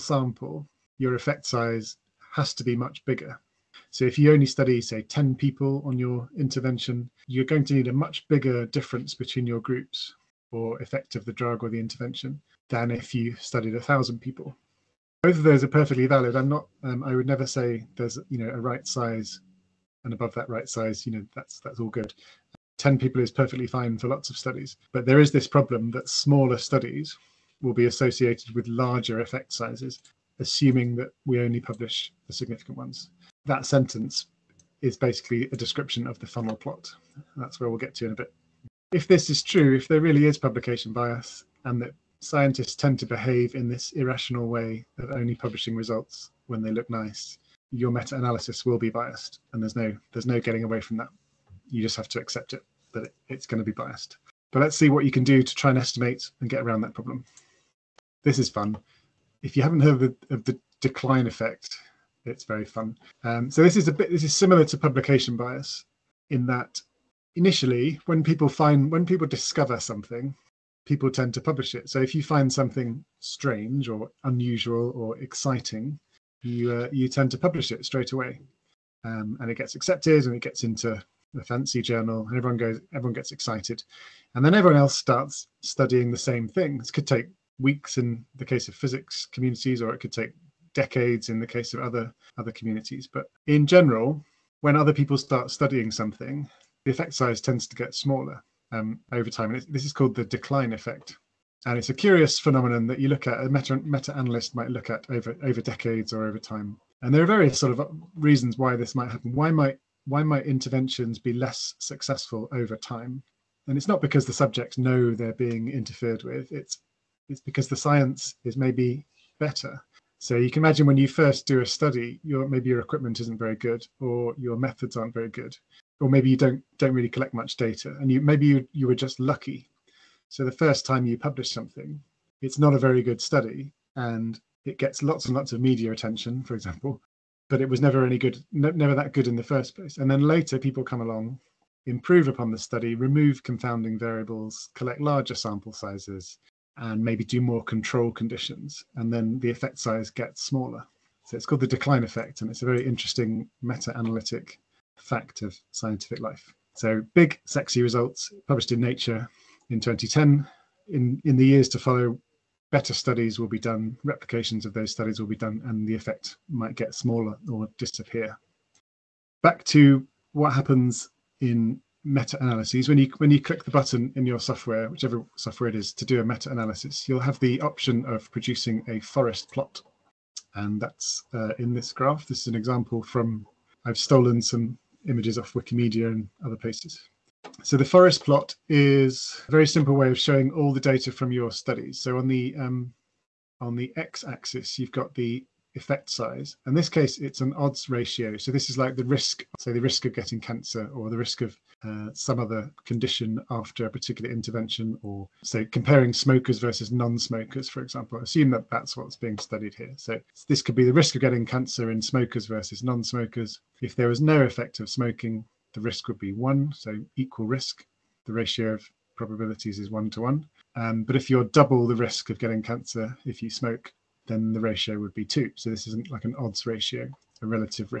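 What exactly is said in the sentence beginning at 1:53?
And it's not because the subjects know they're being interfered with.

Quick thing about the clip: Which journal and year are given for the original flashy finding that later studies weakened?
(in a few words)
Nature in 2010.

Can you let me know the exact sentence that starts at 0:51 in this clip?
You just have to accept it that it, it's going to be biased.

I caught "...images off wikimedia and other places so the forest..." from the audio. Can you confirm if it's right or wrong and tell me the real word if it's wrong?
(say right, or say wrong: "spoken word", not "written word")
right.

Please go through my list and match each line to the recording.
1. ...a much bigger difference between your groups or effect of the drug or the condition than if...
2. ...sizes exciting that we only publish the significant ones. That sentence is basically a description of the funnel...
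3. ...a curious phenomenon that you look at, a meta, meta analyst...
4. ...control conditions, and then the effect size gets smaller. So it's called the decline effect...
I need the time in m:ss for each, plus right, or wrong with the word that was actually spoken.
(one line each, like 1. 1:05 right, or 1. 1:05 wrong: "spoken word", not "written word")
1. 0:07 wrong: "intervention", not "condition"
2. 0:29 wrong: "assuming", not "exciting"
3. 1:41 right
4. 2:27 right.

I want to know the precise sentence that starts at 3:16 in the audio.
In this case, it's an odds ratio.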